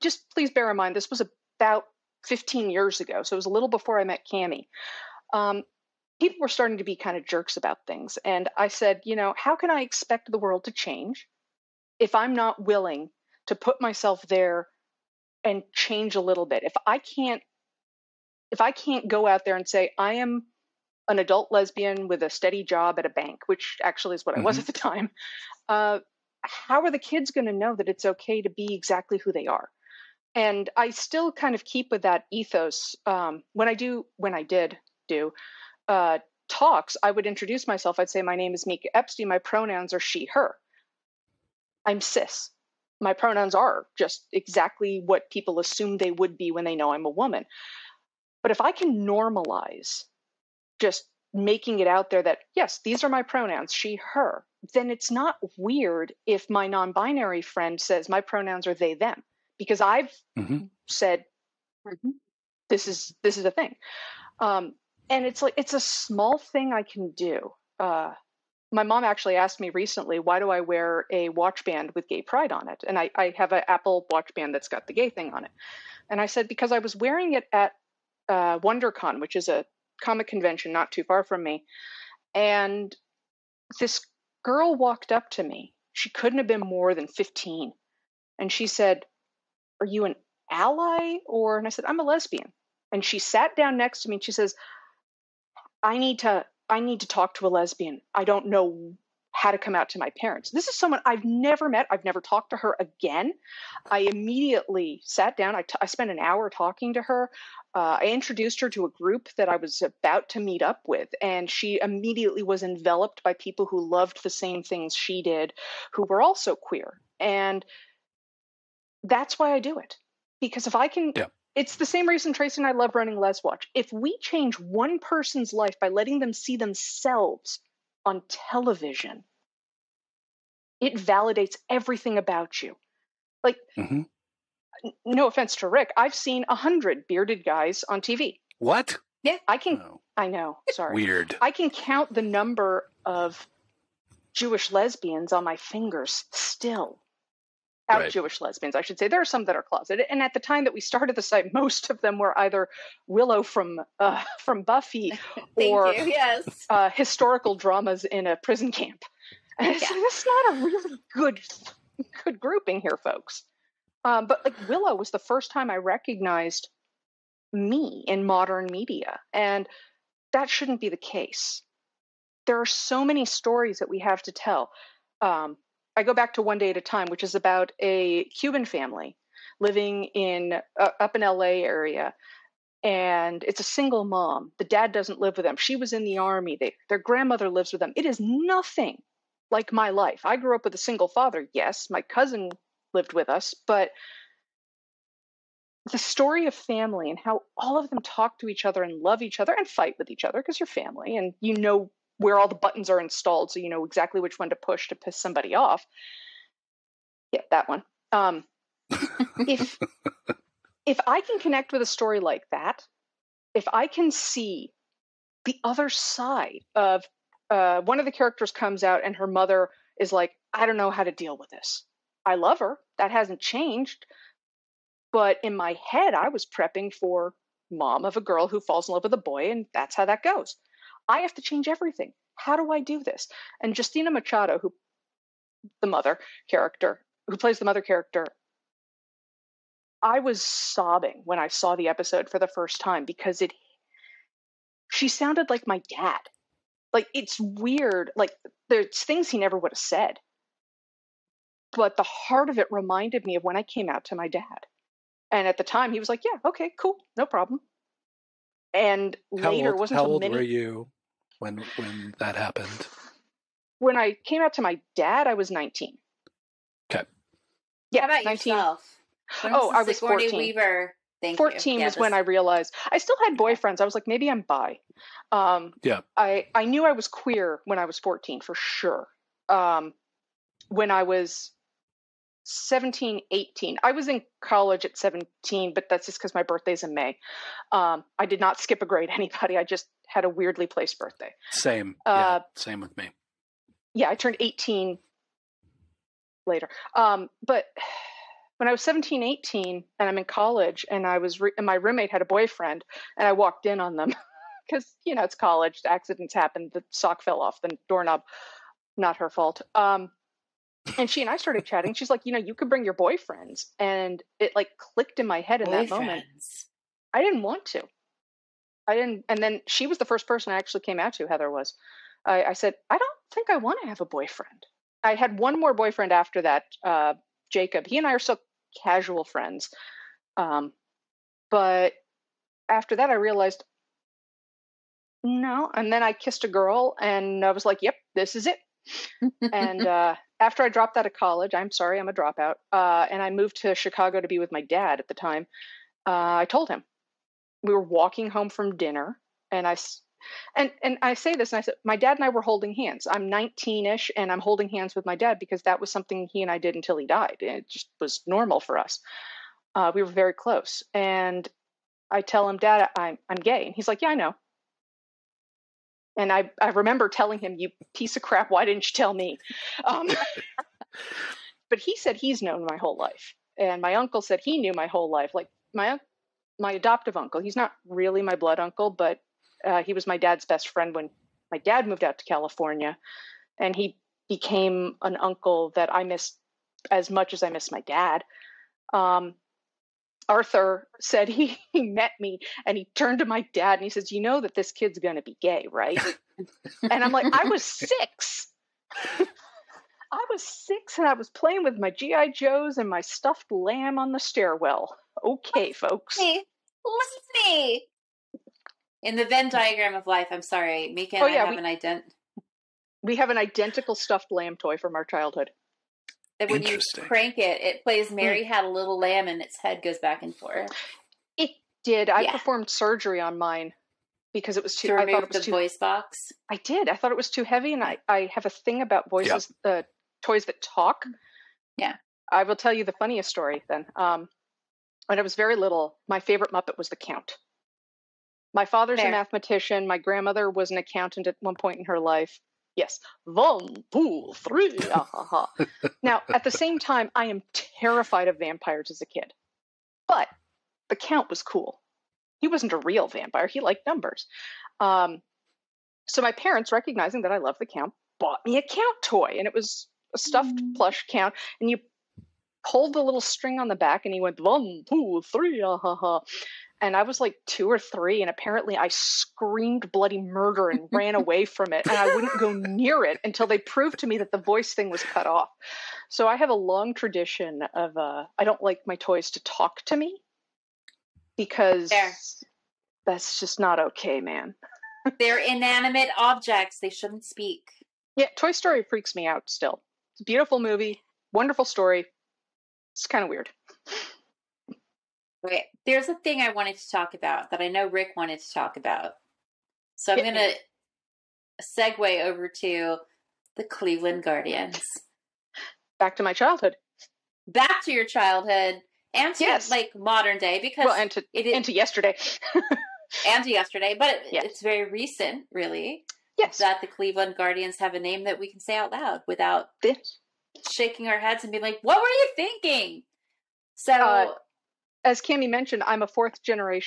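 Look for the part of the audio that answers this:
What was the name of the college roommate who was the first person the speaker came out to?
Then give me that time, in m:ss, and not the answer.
5:21.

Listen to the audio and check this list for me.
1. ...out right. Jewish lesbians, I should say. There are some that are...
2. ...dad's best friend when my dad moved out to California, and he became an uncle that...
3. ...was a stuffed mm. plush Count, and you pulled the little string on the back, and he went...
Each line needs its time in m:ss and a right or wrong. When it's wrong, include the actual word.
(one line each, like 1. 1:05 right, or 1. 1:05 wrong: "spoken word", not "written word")
1. 2:27 right
2. 6:20 right
3. 7:39 right.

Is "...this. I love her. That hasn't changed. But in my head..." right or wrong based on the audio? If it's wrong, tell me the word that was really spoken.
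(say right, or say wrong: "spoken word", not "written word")
right.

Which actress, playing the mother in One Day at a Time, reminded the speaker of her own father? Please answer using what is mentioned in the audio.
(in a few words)
Justina Machado.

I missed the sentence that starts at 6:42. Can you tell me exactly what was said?
Joes and my stuffed lamb on the stairwell.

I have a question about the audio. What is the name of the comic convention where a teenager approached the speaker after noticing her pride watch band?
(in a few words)
WonderCon.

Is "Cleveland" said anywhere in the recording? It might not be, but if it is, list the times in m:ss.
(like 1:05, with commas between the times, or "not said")
8:23, 8:36.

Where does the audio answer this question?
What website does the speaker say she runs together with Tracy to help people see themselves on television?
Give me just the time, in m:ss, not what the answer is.
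2:03.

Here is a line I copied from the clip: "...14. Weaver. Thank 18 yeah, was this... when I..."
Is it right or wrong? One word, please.
wrong.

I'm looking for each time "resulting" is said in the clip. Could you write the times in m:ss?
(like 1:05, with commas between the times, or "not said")
not said.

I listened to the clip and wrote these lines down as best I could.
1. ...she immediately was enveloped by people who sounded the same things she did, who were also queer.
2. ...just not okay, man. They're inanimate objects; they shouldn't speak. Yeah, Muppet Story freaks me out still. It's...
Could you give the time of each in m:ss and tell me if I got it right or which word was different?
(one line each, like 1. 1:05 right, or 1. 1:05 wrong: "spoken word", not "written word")
1. 1:51 wrong: "loved", not "sounded"
2. 8:03 wrong: "Toy", not "Muppet".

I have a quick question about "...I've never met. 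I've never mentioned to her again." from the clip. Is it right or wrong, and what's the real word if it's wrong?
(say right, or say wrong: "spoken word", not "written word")
wrong: "talked", not "mentioned".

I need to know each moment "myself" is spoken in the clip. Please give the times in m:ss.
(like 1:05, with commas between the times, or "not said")
0:13, 0:37.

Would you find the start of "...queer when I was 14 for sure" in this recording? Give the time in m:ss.
4:37.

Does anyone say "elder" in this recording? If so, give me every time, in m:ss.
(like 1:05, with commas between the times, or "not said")
not said.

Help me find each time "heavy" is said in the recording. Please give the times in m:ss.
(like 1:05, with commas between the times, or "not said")
7:07.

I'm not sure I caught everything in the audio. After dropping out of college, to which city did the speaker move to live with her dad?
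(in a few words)
Chicago.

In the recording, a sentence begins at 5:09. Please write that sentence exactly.
Um, and she and I started chatting.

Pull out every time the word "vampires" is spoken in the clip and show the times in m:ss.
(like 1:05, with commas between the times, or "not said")
7:28, 7:33.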